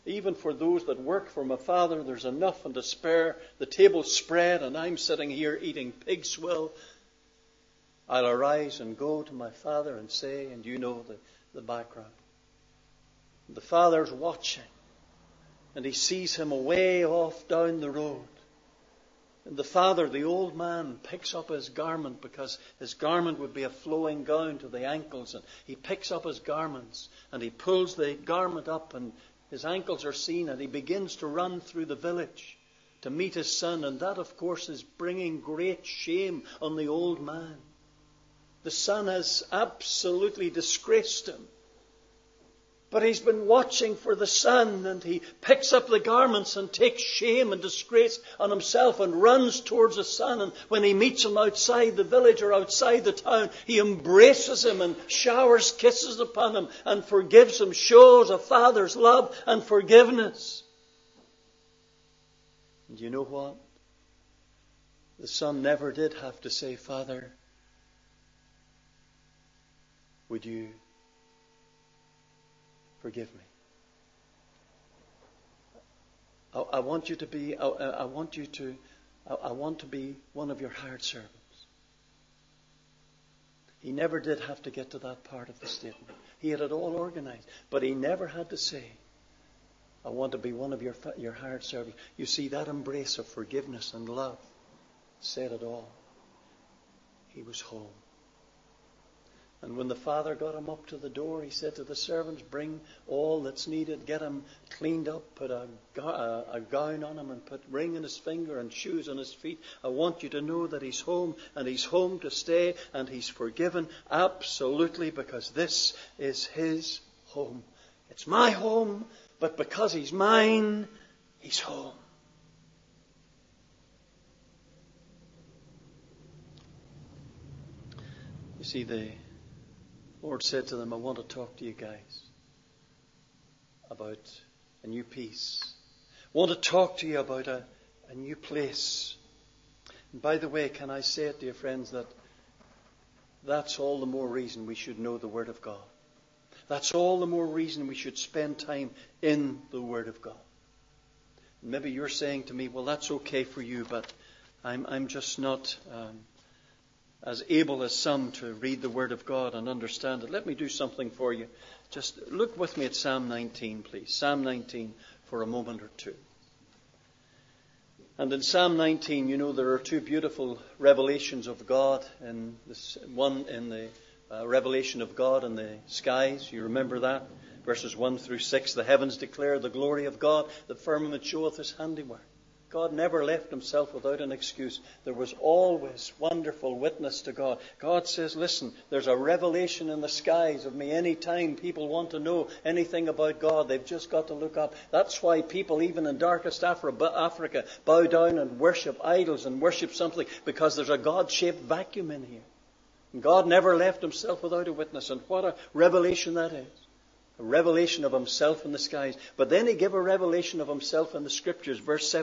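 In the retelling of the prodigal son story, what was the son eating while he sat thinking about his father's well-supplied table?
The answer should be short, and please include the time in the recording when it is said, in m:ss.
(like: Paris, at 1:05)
Pig's swill, at 0:05.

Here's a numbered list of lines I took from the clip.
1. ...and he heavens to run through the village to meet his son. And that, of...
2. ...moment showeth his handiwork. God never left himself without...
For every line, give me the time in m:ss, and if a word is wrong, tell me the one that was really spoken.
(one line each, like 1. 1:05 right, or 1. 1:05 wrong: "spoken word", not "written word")
1. 0:30 wrong: "begins", not "heavens"
2. 3:00 wrong: "firmament", not "moment".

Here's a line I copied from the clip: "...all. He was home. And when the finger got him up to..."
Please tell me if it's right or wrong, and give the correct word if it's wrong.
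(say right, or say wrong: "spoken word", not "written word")
wrong: "father", not "finger".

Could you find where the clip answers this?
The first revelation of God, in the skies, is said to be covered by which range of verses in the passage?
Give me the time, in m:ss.
2:57.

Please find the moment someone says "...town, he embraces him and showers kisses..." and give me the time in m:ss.
0:53.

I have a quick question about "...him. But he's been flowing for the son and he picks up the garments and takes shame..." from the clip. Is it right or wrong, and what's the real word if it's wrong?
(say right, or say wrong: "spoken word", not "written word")
wrong: "watching", not "flowing".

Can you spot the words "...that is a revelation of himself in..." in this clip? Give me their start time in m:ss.
3:26.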